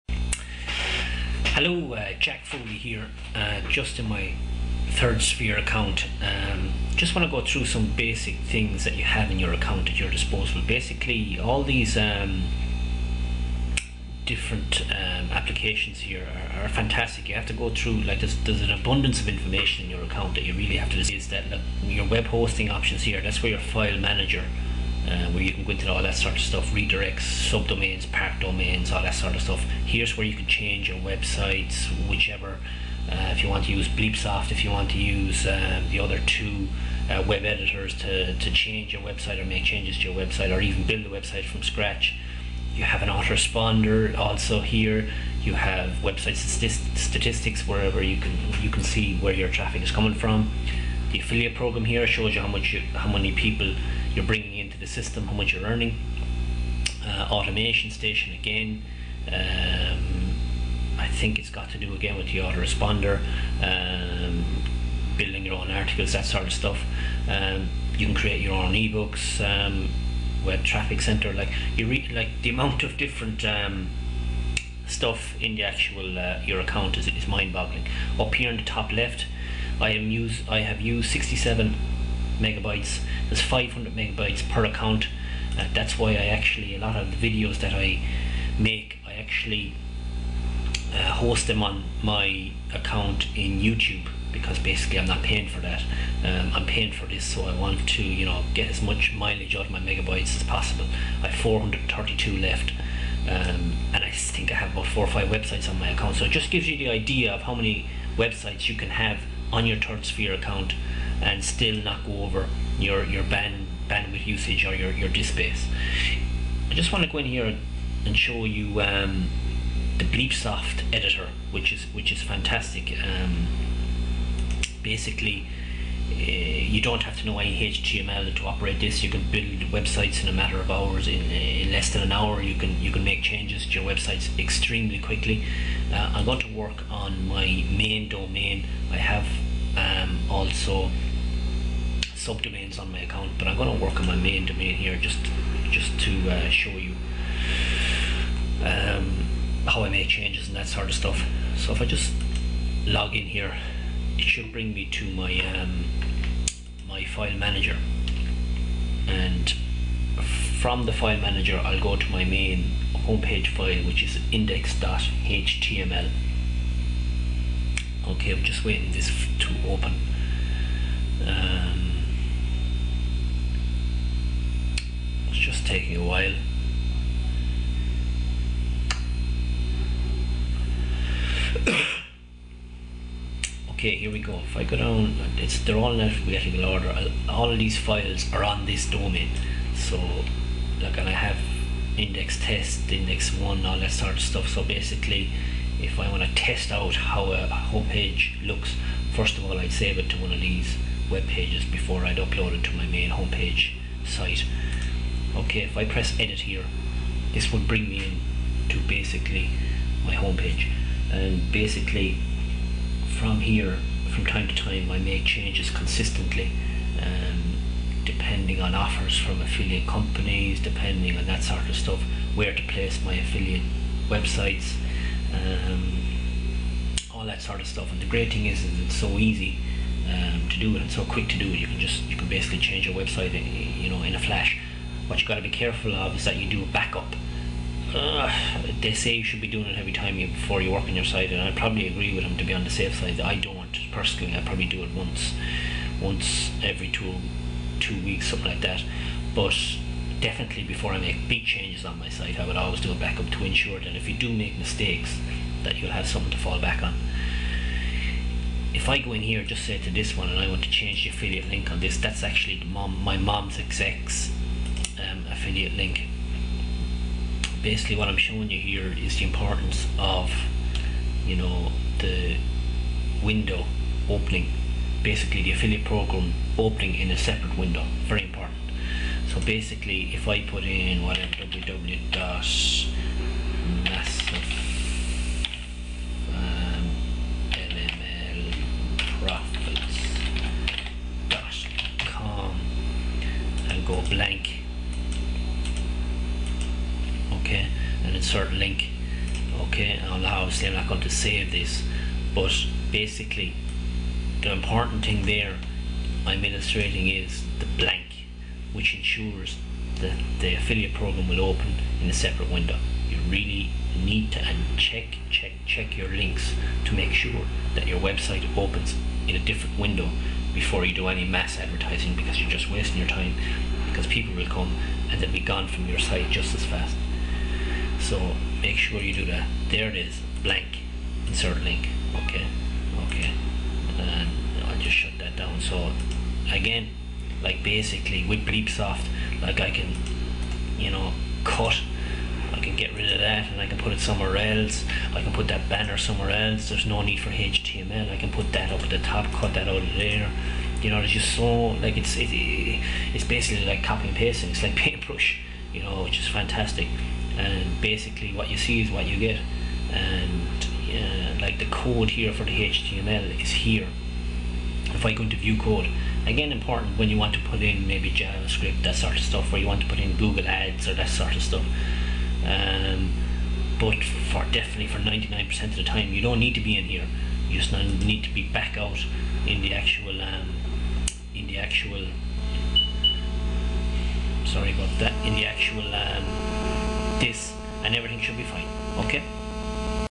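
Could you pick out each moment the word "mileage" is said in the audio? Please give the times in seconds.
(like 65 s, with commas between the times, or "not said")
99 s.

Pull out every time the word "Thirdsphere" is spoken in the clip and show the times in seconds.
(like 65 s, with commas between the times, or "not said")
4 s, 109 s.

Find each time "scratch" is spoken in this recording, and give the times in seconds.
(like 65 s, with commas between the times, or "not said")
41 s.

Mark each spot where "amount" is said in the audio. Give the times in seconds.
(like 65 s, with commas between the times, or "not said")
72 s.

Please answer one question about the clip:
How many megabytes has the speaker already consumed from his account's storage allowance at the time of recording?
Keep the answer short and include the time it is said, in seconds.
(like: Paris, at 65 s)
67 megabytes, at 81 s.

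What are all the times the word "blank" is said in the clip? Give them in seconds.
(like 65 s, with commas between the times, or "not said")
294 s, 307 s, 330 s.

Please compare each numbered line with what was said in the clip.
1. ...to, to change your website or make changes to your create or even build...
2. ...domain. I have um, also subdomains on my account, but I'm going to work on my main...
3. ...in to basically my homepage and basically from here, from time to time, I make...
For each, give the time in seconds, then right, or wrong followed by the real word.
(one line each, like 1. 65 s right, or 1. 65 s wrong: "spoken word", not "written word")
1. 37 s wrong: "website", not "create"
2. 138 s right
3. 208 s right.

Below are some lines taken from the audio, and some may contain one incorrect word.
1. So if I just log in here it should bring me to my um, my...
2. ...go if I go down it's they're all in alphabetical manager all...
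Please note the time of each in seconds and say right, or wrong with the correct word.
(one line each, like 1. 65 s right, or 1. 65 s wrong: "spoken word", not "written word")
1. 151 s right
2. 184 s wrong: "order", not "manager".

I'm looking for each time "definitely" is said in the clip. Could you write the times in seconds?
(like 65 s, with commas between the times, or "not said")
250 s, 374 s.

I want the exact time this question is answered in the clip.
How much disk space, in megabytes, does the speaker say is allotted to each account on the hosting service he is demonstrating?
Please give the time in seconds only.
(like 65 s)
83 s.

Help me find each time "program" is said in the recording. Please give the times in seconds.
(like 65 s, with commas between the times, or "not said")
51 s, 275 s, 310 s.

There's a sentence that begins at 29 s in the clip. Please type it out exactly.
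Here's where you can change your websites, whichever.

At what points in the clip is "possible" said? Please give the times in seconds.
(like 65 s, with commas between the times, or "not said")
100 s.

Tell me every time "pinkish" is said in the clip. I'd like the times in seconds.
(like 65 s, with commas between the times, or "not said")
not said.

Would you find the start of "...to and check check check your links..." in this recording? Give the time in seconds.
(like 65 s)
314 s.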